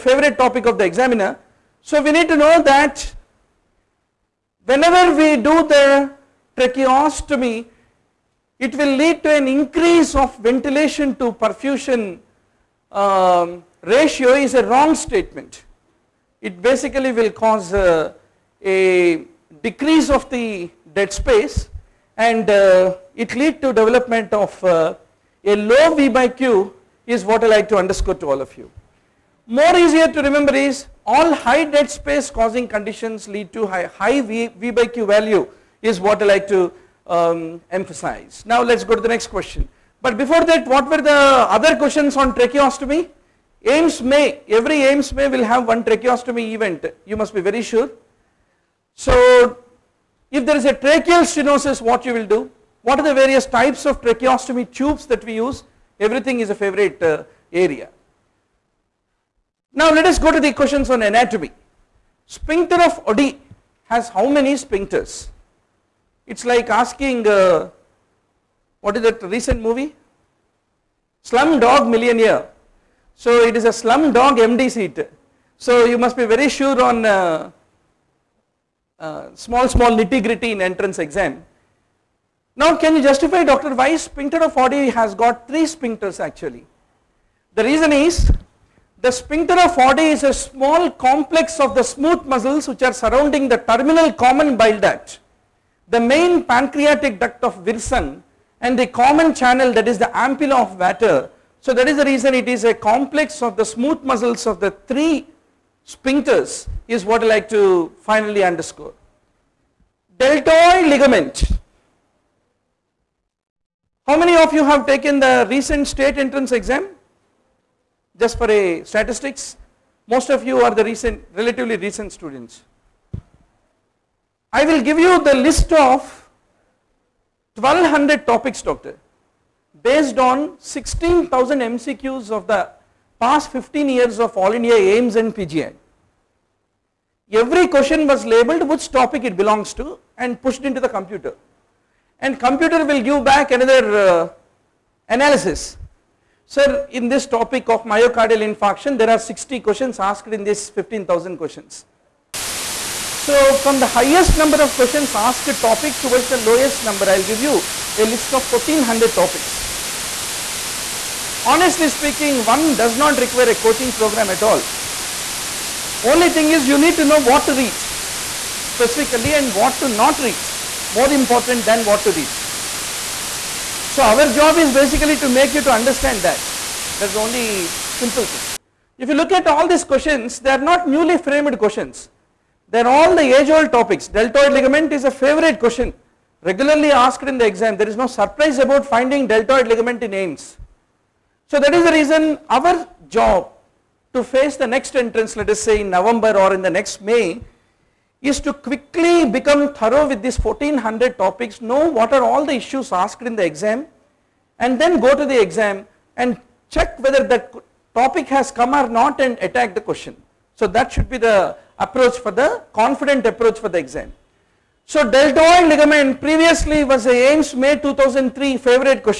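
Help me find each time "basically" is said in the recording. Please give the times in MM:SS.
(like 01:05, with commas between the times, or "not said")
00:16, 02:54.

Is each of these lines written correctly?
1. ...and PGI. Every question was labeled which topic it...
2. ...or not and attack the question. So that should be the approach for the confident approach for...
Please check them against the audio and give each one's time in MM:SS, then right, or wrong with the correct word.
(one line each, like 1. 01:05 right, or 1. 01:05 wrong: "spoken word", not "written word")
1. 02:15 right
2. 03:28 right.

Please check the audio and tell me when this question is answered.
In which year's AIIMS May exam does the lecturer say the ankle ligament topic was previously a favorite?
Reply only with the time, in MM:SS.
03:37.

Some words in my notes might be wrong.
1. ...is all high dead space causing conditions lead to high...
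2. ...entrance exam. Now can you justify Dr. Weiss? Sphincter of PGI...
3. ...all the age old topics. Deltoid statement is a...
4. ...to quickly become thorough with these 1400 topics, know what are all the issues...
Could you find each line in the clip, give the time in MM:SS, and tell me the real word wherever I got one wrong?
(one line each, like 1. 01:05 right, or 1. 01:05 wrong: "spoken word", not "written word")
1. 00:30 right
2. 01:20 wrong: "Oddi", not "PGI"
3. 03:02 wrong: "ligament", not "statement"
4. 03:18 right.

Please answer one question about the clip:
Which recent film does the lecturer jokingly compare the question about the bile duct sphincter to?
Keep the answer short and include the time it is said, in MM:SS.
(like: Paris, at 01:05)
Slumdog Millionaire, at 01:11.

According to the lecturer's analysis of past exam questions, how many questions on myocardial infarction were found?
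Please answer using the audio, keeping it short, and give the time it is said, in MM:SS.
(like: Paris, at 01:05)
60, at 02:29.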